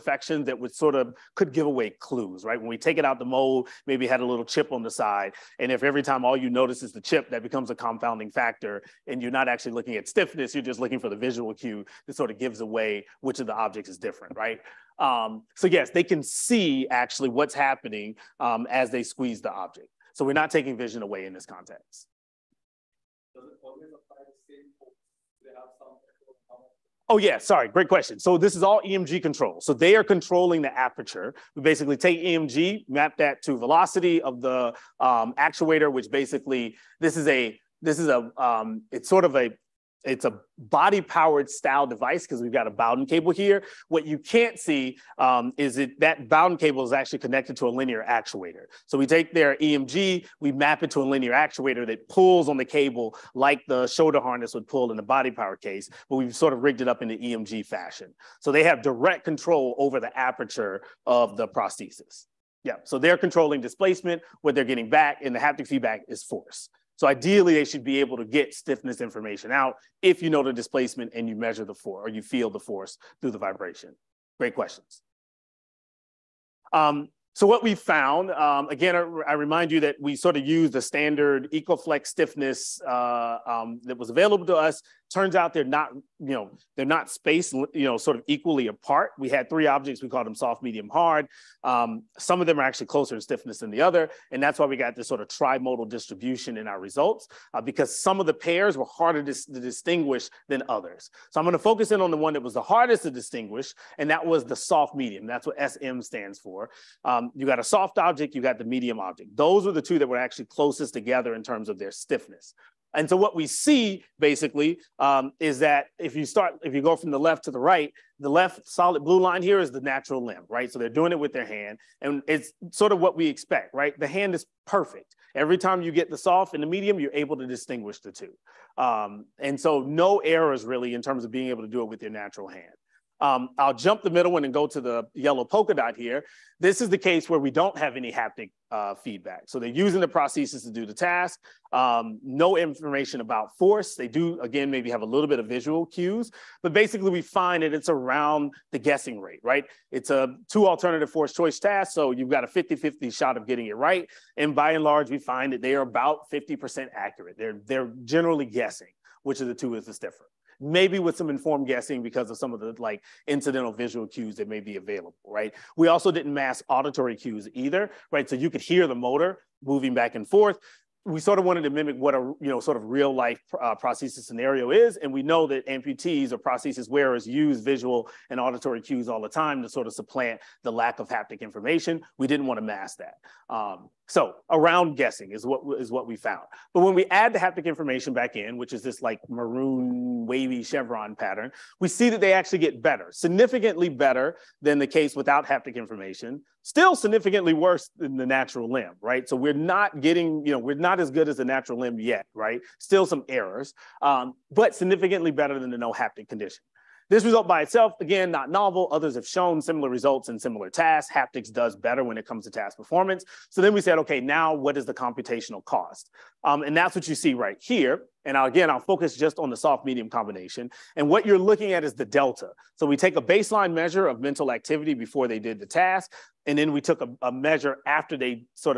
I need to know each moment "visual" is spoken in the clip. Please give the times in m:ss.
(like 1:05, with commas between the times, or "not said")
0:11, 2:25, 2:43, 2:57.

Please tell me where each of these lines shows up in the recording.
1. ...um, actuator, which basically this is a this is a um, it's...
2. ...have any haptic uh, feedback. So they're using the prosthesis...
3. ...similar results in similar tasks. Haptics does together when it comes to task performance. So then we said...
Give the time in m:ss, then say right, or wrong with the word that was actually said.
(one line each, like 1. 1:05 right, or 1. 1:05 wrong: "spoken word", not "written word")
1. 0:34 right
2. 2:17 right
3. 3:29 wrong: "better", not "together".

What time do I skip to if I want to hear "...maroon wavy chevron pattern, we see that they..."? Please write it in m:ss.
3:09.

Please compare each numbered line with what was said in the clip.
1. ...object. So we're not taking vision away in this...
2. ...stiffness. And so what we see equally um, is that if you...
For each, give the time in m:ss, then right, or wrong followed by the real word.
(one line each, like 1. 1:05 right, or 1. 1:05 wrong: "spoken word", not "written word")
1. 0:19 right
2. 1:51 wrong: "basically", not "equally".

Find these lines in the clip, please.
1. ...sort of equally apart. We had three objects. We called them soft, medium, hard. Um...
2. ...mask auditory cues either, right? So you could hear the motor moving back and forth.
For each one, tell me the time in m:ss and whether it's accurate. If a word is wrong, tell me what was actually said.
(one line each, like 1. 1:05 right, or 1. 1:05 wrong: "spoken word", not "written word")
1. 1:27 right
2. 2:46 right.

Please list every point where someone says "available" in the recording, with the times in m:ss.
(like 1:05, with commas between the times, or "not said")
1:24, 2:44.